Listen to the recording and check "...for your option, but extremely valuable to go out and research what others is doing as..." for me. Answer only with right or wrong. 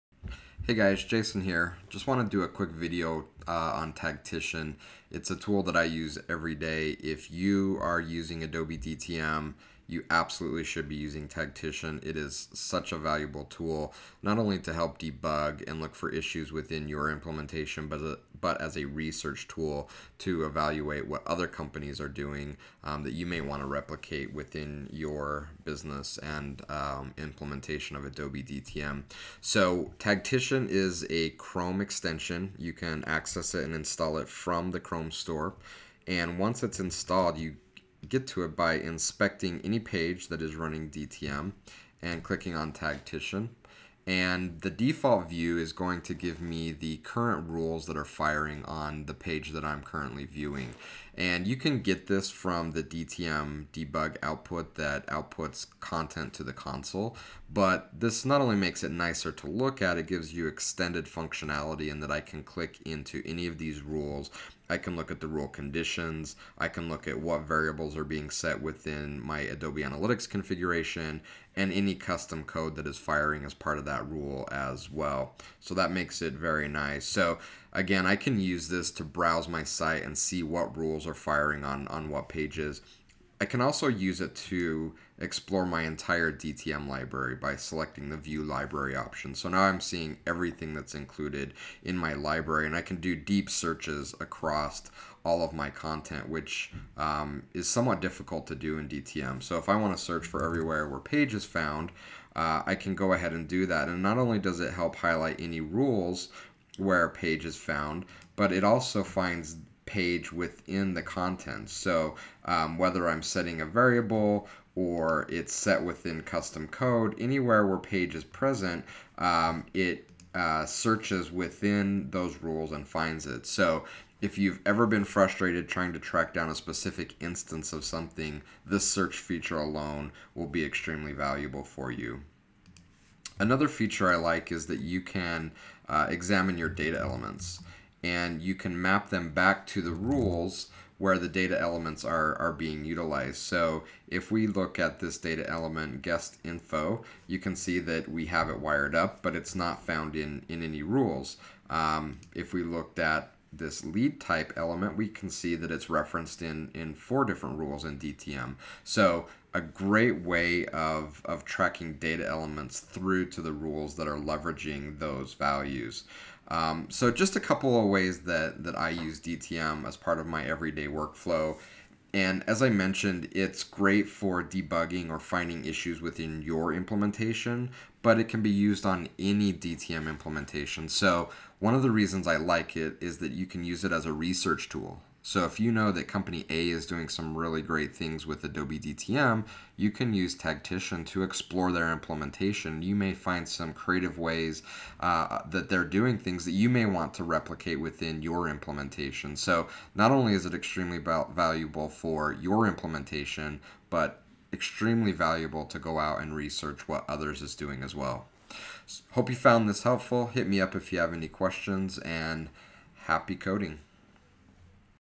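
wrong.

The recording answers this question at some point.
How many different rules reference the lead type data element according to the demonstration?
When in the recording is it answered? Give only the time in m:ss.
2:36.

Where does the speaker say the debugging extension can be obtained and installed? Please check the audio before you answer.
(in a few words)
Chrome store.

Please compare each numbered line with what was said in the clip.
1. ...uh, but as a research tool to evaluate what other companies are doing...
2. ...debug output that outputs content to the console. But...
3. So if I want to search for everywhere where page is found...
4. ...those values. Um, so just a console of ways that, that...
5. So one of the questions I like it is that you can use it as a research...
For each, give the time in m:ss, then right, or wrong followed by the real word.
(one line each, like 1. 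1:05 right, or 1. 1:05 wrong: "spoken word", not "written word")
1. 0:18 right
2. 0:53 right
3. 1:39 right
4. 2:44 wrong: "couple", not "console"
5. 3:00 wrong: "reasons", not "questions".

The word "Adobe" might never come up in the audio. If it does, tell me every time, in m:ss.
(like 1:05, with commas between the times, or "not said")
0:08, 0:28, 1:09, 3:08.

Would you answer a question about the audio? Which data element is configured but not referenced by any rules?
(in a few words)
guest info.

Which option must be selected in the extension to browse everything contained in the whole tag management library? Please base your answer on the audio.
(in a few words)
view library.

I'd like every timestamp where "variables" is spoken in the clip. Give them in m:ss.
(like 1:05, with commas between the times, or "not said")
1:07, 1:53.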